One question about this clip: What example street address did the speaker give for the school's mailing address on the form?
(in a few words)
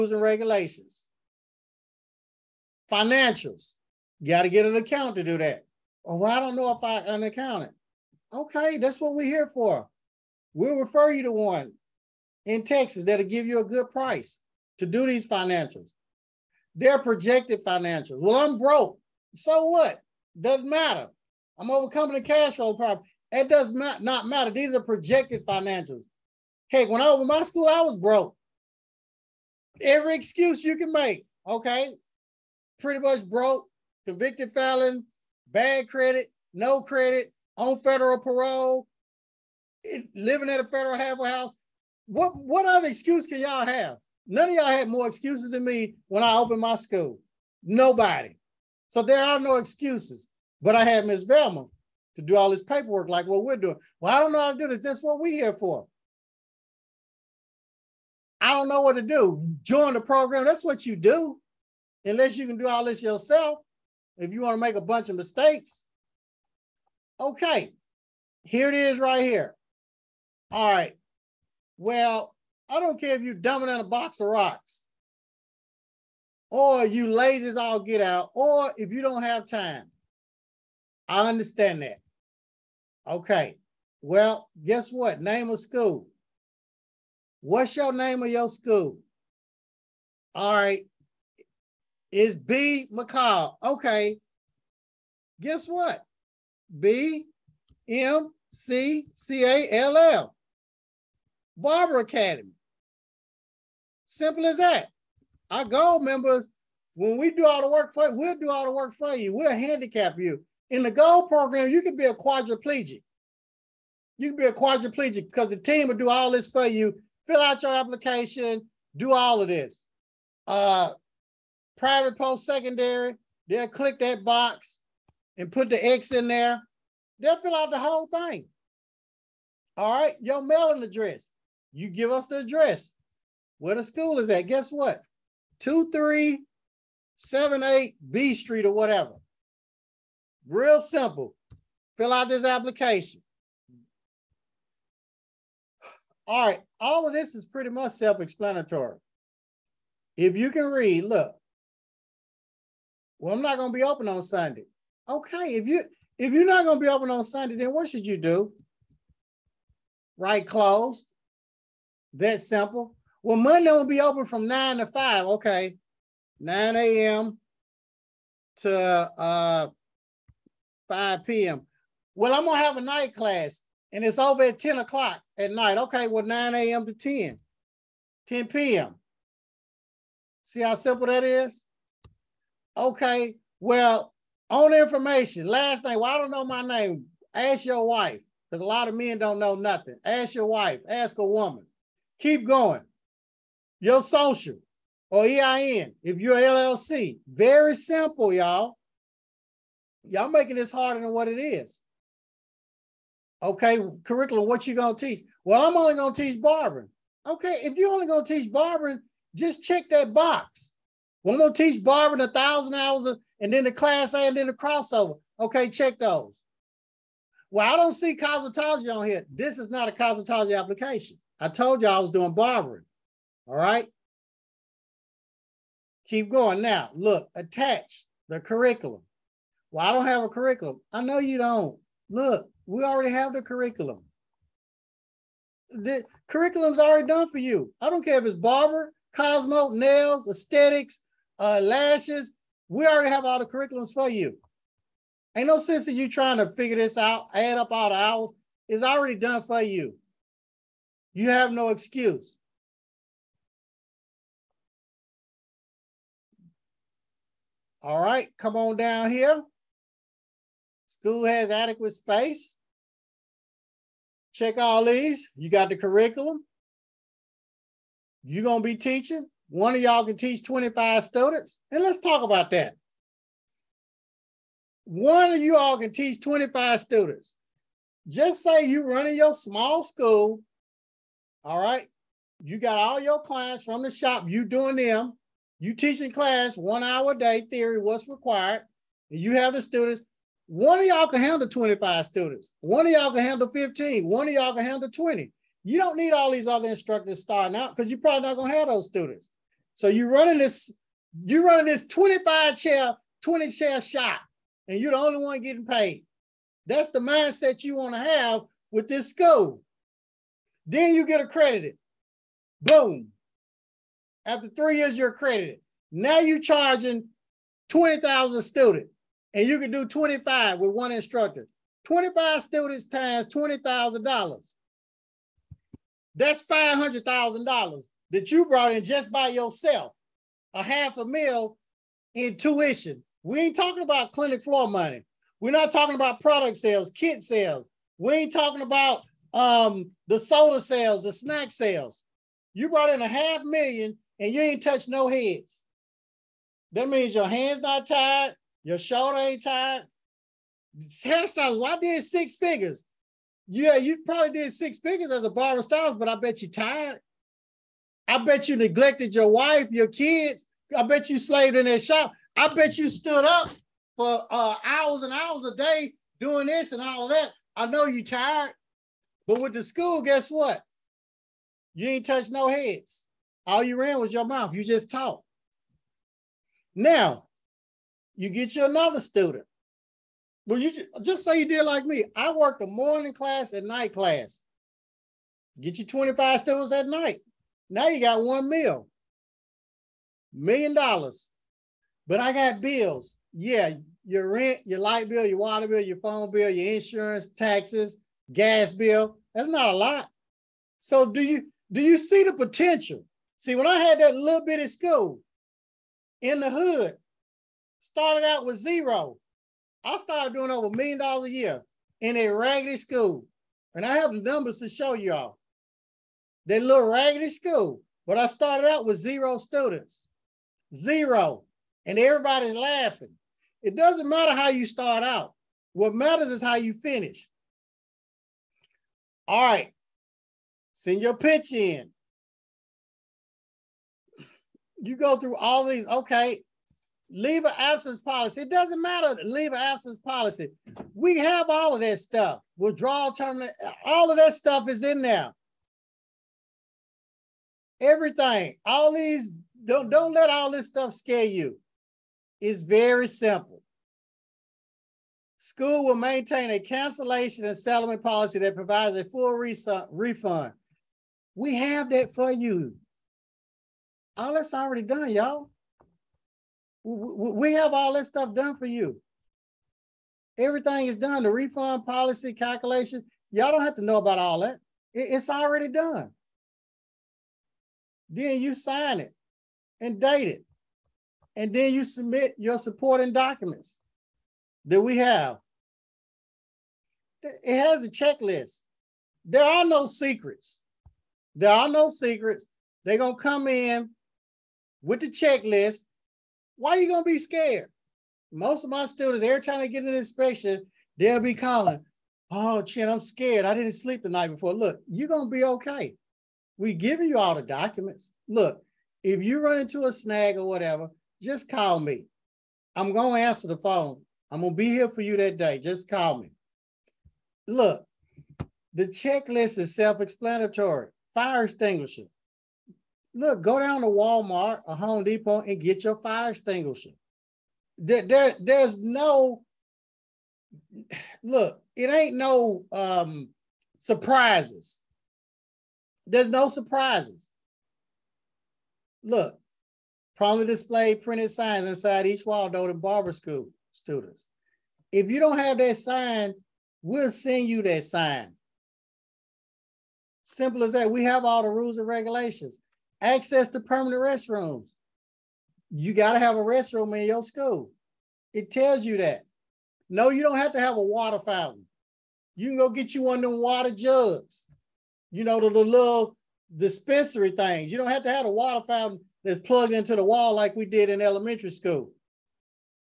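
2378 B Street.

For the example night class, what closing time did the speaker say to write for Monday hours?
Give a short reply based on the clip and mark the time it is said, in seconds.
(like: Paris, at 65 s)
10 p.m., at 178 s.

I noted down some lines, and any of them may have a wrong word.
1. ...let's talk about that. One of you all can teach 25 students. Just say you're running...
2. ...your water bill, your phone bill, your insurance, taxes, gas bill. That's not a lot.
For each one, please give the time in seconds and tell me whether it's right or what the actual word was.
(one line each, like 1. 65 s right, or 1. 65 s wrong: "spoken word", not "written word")
1. 271 s right
2. 395 s right.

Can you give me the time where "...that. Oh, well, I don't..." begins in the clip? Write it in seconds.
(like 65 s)
5 s.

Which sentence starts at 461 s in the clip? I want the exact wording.
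We have that for you all that's already done, y'all.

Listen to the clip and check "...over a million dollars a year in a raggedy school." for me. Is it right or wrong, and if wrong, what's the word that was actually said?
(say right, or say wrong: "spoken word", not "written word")
right.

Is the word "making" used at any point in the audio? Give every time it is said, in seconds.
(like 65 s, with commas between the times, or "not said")
200 s.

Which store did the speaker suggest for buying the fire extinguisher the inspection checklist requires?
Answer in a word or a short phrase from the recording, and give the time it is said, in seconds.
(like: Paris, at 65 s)
Walmart, at 523 s.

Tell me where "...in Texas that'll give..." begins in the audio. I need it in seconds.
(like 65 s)
12 s.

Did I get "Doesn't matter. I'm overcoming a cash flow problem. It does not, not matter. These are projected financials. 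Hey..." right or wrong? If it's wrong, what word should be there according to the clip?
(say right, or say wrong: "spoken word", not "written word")
right.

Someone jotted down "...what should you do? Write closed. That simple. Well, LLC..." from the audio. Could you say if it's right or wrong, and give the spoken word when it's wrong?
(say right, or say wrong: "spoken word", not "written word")
wrong: "Monday", not "LLC".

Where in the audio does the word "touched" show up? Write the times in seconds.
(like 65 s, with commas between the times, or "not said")
344 s, 372 s.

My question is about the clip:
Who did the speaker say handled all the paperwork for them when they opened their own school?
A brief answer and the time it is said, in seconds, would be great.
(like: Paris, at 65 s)
Miss Velma, at 51 s.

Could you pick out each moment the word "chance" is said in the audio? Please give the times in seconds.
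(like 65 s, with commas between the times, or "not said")
not said.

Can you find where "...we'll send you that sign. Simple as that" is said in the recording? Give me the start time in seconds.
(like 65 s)
546 s.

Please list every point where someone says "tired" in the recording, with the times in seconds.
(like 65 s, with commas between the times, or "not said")
356 s, 368 s.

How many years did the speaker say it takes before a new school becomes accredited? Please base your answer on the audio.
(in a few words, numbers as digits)
3 years.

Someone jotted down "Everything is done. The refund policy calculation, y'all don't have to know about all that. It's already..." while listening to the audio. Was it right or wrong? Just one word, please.
right.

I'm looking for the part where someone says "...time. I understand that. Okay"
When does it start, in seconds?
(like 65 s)
79 s.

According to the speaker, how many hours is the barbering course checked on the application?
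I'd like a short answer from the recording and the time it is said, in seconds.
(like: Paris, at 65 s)
1,000 hours, at 212 s.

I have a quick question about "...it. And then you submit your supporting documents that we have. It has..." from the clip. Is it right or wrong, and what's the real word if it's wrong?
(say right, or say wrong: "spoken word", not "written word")
right.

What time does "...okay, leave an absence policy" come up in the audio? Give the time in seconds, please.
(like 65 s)
435 s.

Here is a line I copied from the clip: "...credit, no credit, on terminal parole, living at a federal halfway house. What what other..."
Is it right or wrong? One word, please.
wrong.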